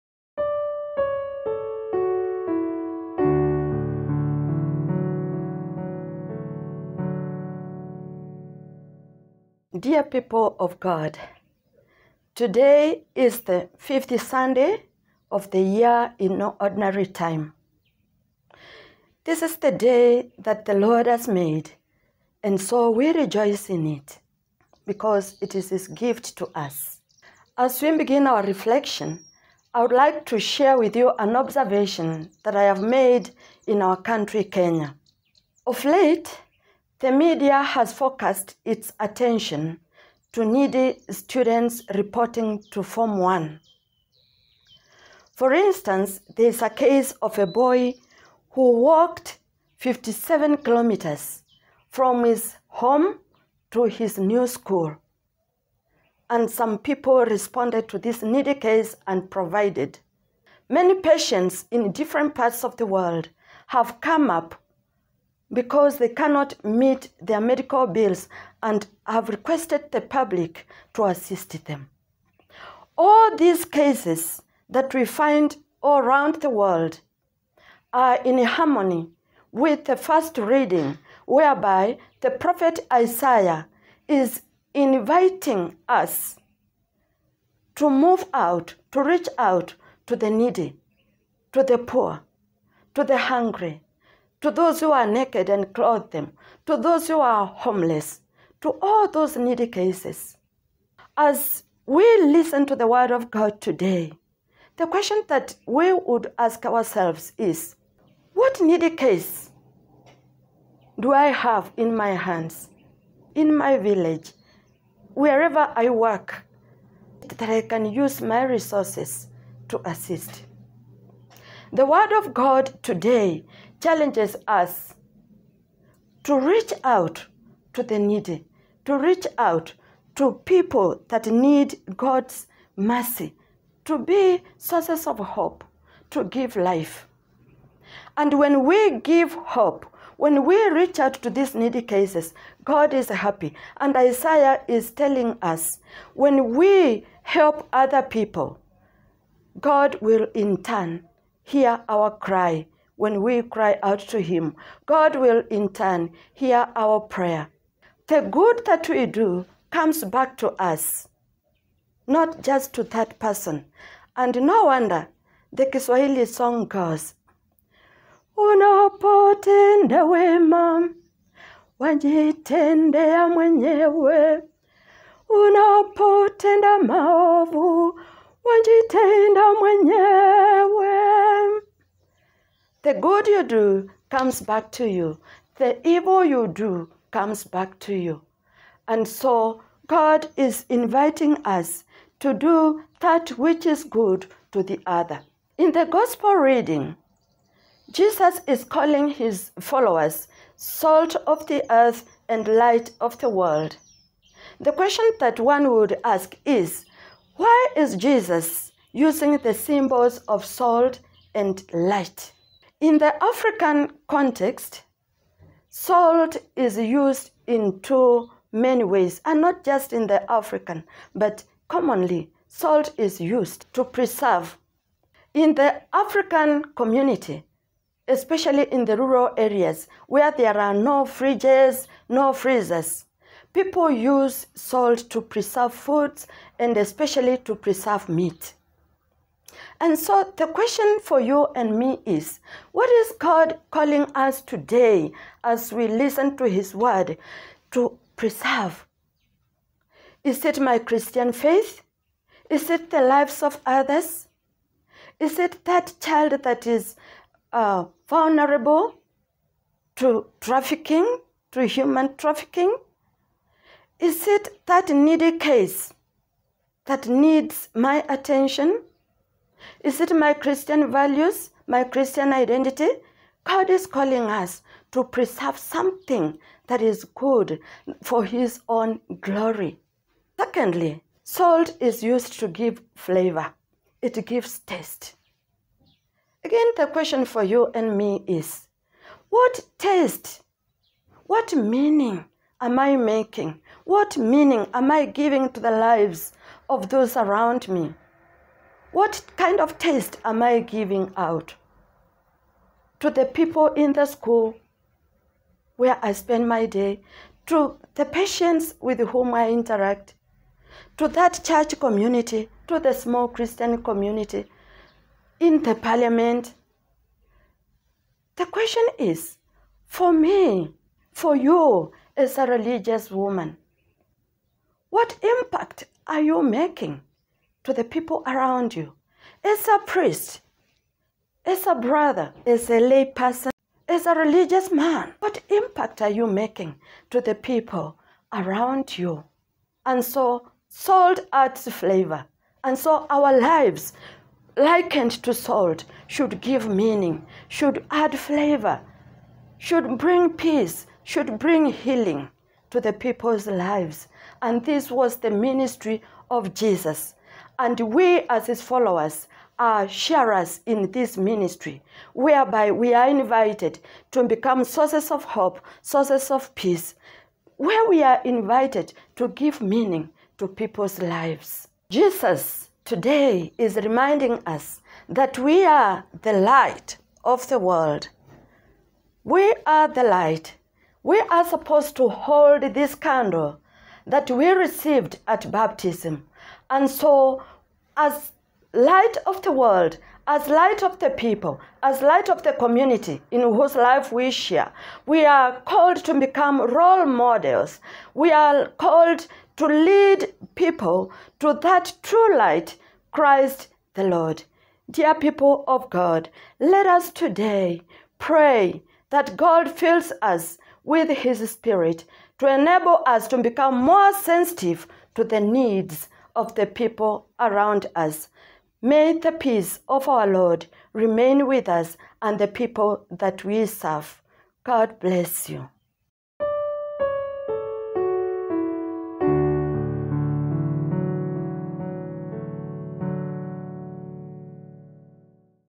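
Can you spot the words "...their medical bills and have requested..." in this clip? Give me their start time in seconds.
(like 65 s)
67 s.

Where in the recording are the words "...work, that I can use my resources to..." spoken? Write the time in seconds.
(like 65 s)
115 s.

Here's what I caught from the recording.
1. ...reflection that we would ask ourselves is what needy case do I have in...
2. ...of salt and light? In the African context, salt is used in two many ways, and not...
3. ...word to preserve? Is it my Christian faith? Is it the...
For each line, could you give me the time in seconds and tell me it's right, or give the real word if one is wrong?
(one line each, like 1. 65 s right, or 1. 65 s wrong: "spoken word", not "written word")
1. 104 s wrong: "question", not "reflection"
2. 210 s right
3. 246 s right.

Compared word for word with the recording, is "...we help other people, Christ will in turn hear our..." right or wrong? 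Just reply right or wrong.
wrong.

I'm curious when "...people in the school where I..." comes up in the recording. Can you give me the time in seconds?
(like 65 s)
303 s.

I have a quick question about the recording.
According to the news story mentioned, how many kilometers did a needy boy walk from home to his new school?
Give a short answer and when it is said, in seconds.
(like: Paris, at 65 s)
57, at 49 s.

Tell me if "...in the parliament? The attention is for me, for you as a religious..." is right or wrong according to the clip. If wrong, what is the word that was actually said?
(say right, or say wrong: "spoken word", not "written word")
wrong: "question", not "attention".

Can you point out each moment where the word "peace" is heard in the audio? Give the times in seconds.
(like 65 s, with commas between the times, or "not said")
350 s, 366 s, 419 s.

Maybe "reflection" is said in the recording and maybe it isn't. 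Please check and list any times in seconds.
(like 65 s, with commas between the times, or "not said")
28 s.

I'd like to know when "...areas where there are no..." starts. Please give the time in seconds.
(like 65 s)
229 s.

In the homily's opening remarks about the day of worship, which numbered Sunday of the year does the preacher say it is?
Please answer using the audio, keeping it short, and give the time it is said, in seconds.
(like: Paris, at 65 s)
50th, at 13 s.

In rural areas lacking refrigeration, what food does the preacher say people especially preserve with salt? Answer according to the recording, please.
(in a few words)
meat.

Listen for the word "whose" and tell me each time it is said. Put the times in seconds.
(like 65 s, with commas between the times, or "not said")
393 s.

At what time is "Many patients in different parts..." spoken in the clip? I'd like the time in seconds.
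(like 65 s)
60 s.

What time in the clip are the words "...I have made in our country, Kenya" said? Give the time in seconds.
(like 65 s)
32 s.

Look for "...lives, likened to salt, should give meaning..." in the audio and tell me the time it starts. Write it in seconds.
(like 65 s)
343 s.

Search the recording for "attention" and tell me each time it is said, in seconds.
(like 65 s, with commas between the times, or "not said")
38 s, 268 s.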